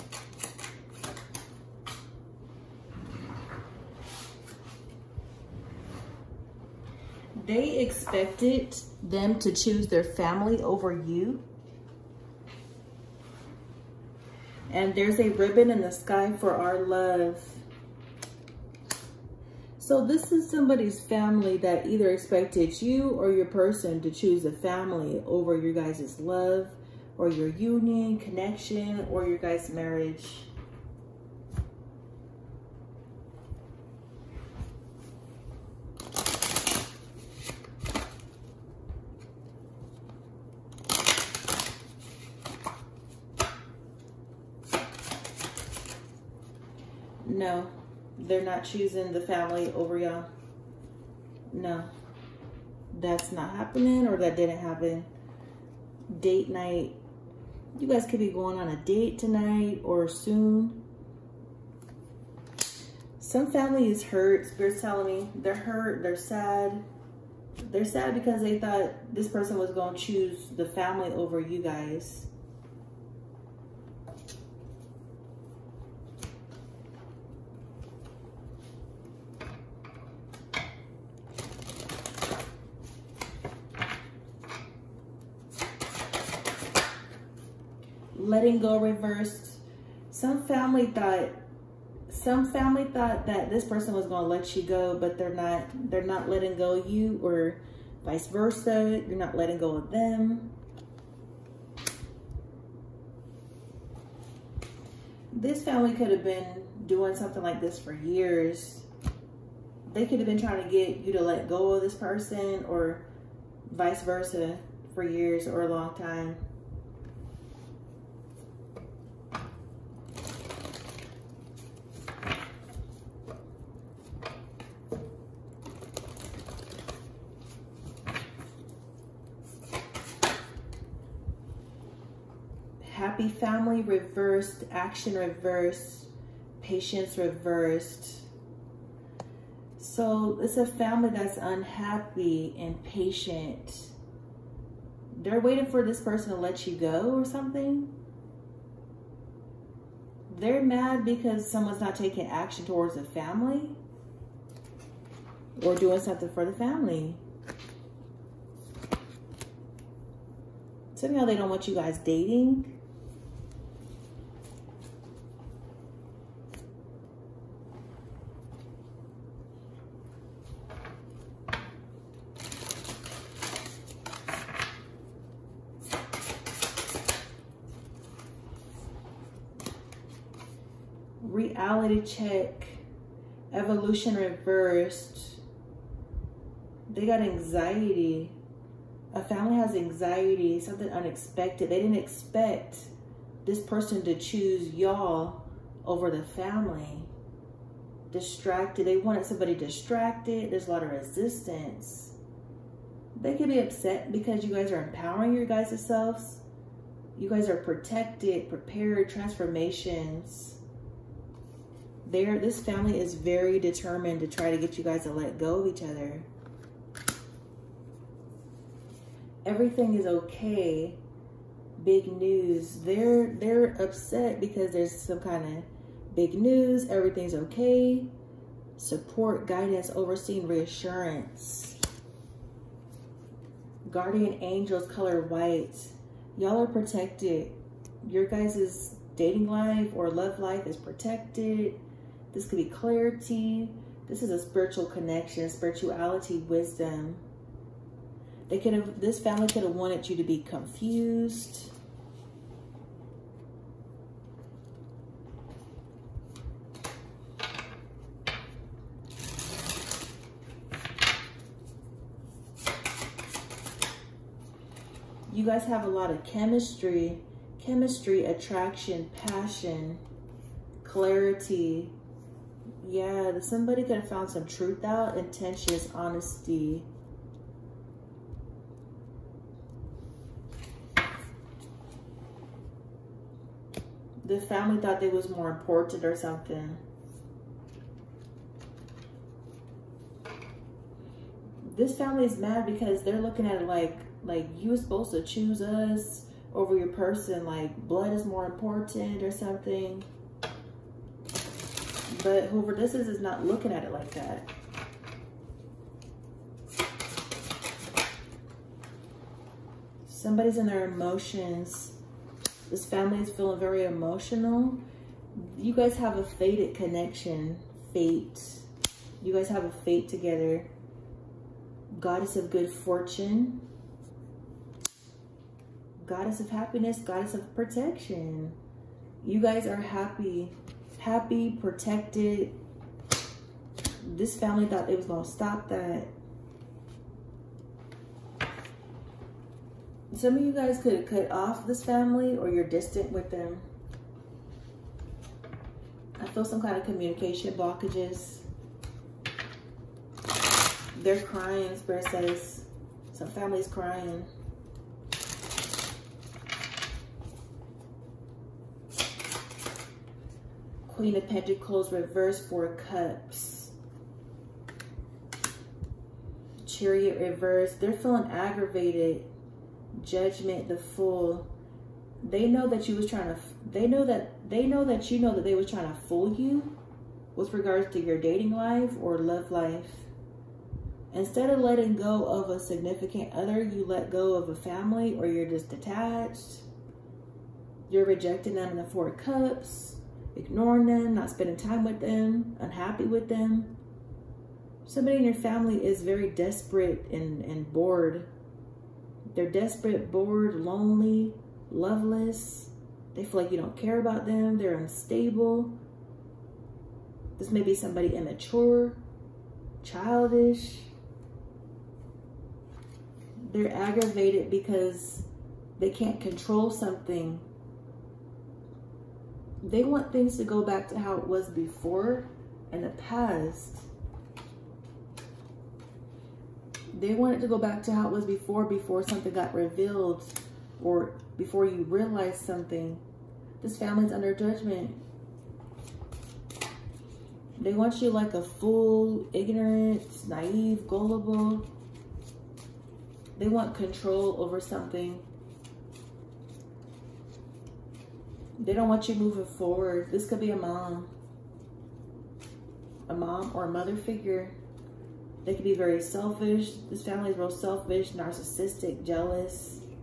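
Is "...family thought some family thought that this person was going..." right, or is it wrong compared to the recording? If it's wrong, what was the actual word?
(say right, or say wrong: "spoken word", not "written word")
right.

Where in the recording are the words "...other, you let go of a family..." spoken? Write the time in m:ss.
6:23.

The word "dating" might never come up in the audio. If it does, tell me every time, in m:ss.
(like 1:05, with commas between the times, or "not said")
2:41, 3:59, 6:18.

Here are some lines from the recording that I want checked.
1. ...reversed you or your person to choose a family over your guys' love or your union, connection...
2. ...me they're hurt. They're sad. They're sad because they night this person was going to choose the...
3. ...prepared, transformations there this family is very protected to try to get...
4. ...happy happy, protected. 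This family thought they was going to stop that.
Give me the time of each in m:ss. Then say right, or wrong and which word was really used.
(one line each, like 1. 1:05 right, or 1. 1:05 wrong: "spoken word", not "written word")
1. 0:22 wrong: "expected", not "reversed"
2. 1:05 wrong: "thought", not "night"
3. 3:28 wrong: "determined", not "protected"
4. 5:29 right.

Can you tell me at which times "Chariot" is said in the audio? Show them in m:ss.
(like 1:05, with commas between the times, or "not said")
6:06.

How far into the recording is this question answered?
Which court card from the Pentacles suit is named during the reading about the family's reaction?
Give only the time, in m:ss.
6:00.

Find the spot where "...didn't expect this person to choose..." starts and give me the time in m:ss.
3:11.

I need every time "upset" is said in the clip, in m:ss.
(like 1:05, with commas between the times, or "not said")
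3:23, 3:43.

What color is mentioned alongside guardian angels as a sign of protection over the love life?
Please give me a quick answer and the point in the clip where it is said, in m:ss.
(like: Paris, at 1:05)
White, at 3:54.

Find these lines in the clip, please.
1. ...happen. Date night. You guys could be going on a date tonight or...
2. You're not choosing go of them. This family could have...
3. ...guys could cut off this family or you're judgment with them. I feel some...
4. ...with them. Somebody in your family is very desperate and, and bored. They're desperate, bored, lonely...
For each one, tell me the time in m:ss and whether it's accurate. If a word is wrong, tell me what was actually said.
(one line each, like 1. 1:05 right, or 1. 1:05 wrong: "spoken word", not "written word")
1. 0:54 right
2. 1:39 wrong: "letting", not "choosing"
3. 5:40 wrong: "distant", not "judgment"
4. 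6:33 right.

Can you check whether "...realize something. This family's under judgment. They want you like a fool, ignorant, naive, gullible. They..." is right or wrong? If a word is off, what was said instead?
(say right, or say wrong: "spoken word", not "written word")
right.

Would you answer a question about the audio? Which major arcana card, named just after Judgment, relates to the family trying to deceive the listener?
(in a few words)
The Fool.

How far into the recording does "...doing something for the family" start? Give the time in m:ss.
2:35.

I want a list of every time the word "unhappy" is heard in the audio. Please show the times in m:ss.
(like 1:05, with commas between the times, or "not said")
2:21, 6:32.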